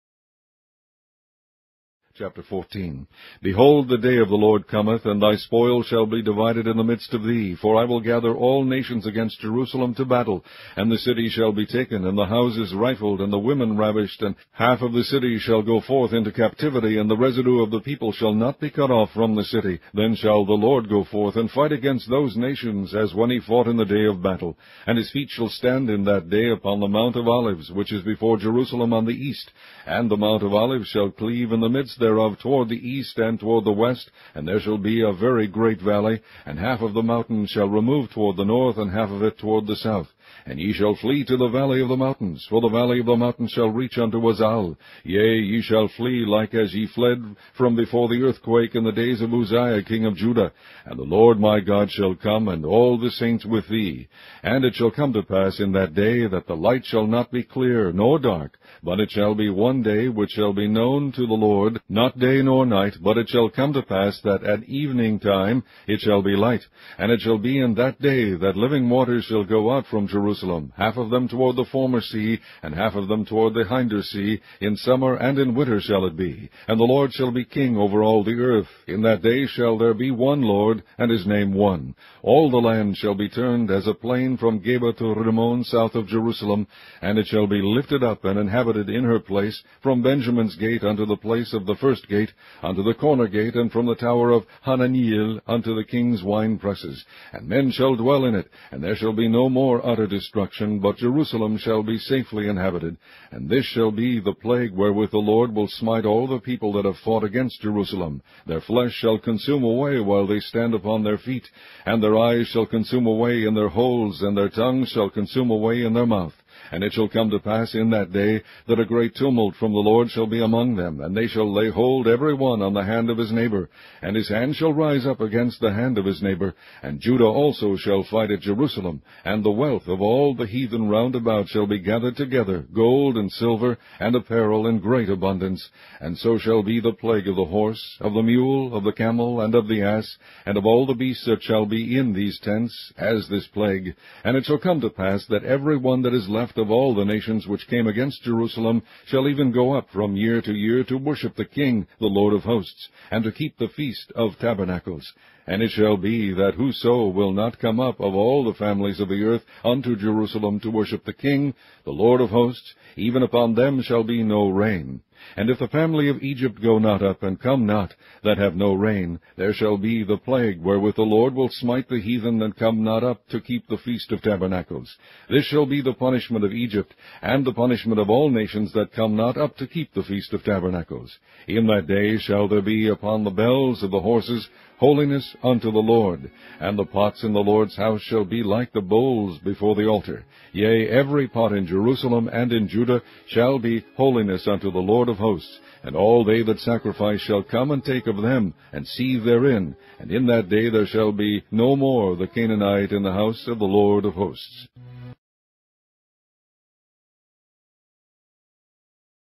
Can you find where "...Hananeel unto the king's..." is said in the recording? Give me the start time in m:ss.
1:34.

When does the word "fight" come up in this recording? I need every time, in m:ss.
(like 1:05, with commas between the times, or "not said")
0:21, 2:08.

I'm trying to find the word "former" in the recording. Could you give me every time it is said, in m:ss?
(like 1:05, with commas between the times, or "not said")
1:11.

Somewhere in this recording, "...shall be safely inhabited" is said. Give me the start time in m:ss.
1:41.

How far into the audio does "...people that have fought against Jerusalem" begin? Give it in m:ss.
1:46.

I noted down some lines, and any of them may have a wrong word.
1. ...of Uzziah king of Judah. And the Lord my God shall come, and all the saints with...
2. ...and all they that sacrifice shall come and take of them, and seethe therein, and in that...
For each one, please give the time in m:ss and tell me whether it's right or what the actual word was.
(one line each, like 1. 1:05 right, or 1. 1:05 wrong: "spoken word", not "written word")
1. 0:49 right
2. 3:15 right.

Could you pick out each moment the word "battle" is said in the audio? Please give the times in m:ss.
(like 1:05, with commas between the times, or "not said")
0:10, 0:24.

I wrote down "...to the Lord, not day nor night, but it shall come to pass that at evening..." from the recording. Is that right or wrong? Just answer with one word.
right.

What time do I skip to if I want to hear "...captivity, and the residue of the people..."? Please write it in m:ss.
0:16.